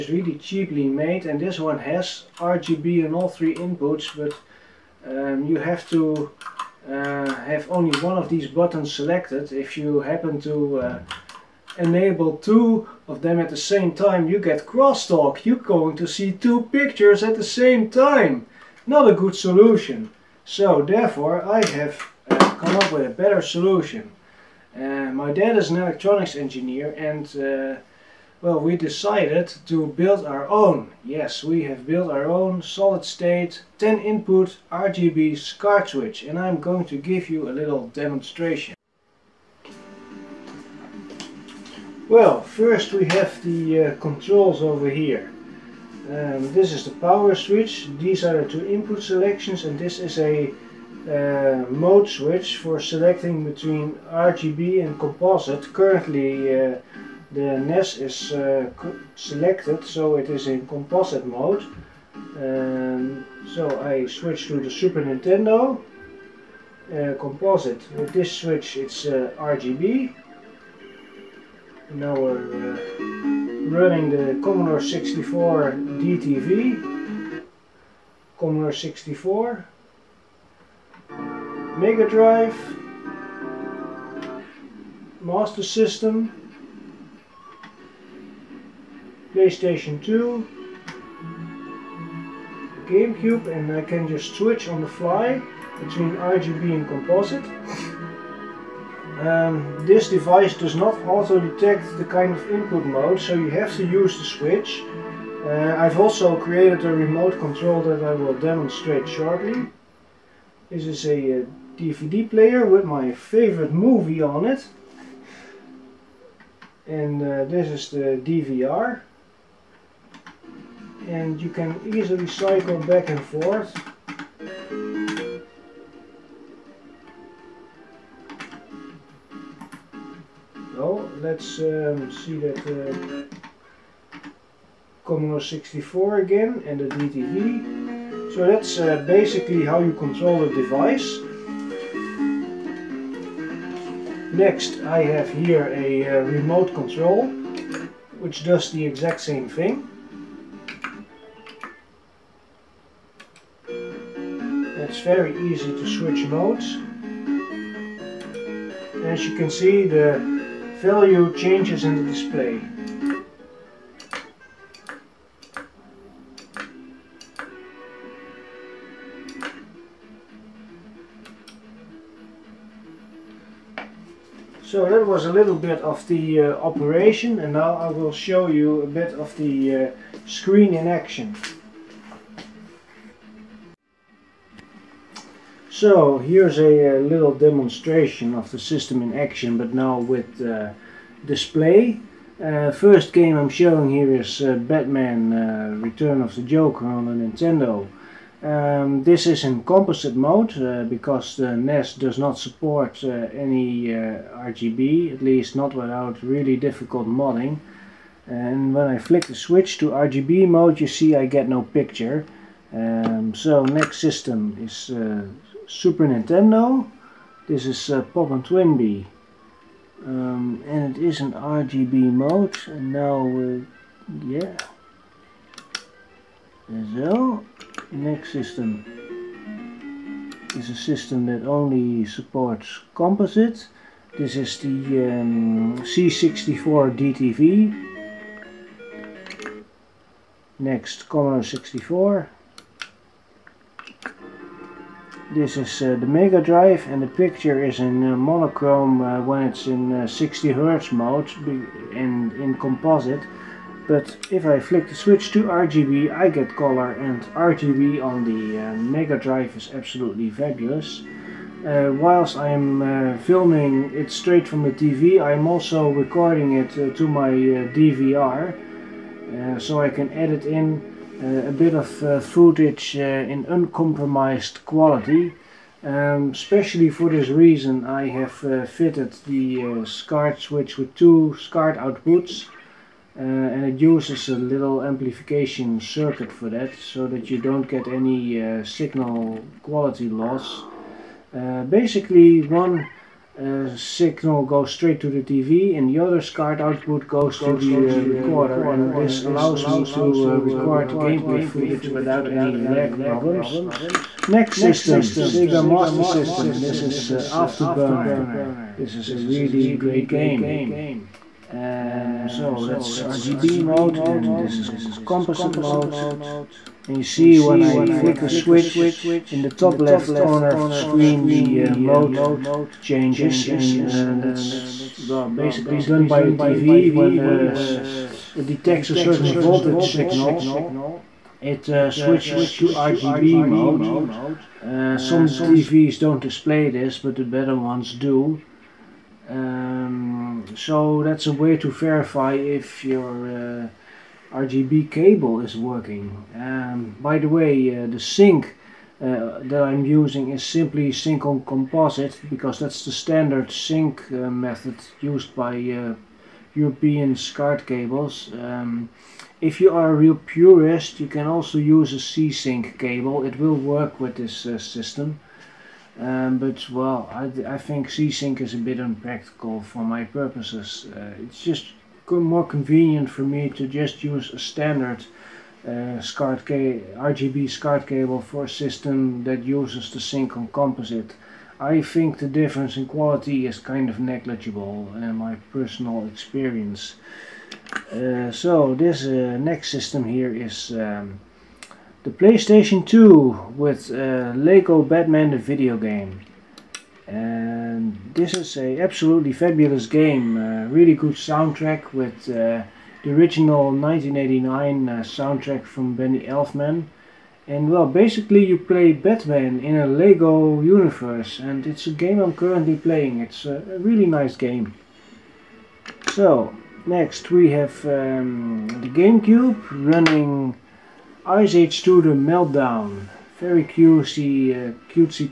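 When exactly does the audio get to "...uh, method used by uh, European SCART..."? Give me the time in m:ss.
5:54.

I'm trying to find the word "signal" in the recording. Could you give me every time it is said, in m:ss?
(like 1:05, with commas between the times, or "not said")
4:48, 4:53, 5:29.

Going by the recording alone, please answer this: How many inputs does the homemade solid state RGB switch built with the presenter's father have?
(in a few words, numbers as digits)
10.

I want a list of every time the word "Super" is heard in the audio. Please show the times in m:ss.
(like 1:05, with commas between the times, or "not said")
1:04, 3:35.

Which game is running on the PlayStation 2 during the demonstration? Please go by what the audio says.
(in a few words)
Lego Batman.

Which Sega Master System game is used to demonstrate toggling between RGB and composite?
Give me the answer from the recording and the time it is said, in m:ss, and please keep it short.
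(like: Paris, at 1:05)
Afterburner, at 5:07.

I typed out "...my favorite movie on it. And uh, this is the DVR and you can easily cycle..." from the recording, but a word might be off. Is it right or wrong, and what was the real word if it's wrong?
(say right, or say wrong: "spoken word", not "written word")
right.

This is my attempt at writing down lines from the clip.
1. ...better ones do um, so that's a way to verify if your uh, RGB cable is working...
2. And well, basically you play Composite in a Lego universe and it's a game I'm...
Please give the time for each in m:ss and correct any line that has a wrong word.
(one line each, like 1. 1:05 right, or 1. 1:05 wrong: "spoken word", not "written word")
1. 5:37 right
2. 6:47 wrong: "Batman", not "Composite".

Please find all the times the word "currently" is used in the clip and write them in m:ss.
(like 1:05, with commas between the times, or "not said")
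0:55, 6:52.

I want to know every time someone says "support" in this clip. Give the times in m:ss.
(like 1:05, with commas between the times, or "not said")
3:22, 3:52.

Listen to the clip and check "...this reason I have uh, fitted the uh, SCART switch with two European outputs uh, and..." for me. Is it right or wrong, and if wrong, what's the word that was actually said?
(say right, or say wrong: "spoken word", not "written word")
wrong: "SCART", not "European".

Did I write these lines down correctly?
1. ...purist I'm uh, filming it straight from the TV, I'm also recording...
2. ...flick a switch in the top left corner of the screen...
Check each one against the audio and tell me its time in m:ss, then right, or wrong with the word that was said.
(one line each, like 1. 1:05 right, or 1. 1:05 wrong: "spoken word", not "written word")
1. 4:21 wrong: "whilst", not "purist"
2. 5:17 right.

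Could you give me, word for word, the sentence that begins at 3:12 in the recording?
Uh, first game I'm showing here is uh, Batman uh, Return of the Joker on the Nintendo.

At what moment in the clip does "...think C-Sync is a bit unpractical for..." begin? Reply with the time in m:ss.
6:07.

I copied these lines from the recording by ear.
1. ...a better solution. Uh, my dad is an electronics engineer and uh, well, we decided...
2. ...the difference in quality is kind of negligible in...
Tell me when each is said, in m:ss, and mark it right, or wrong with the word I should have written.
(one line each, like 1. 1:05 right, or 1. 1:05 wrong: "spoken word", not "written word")
1. 0:23 right
2. 6:22 right.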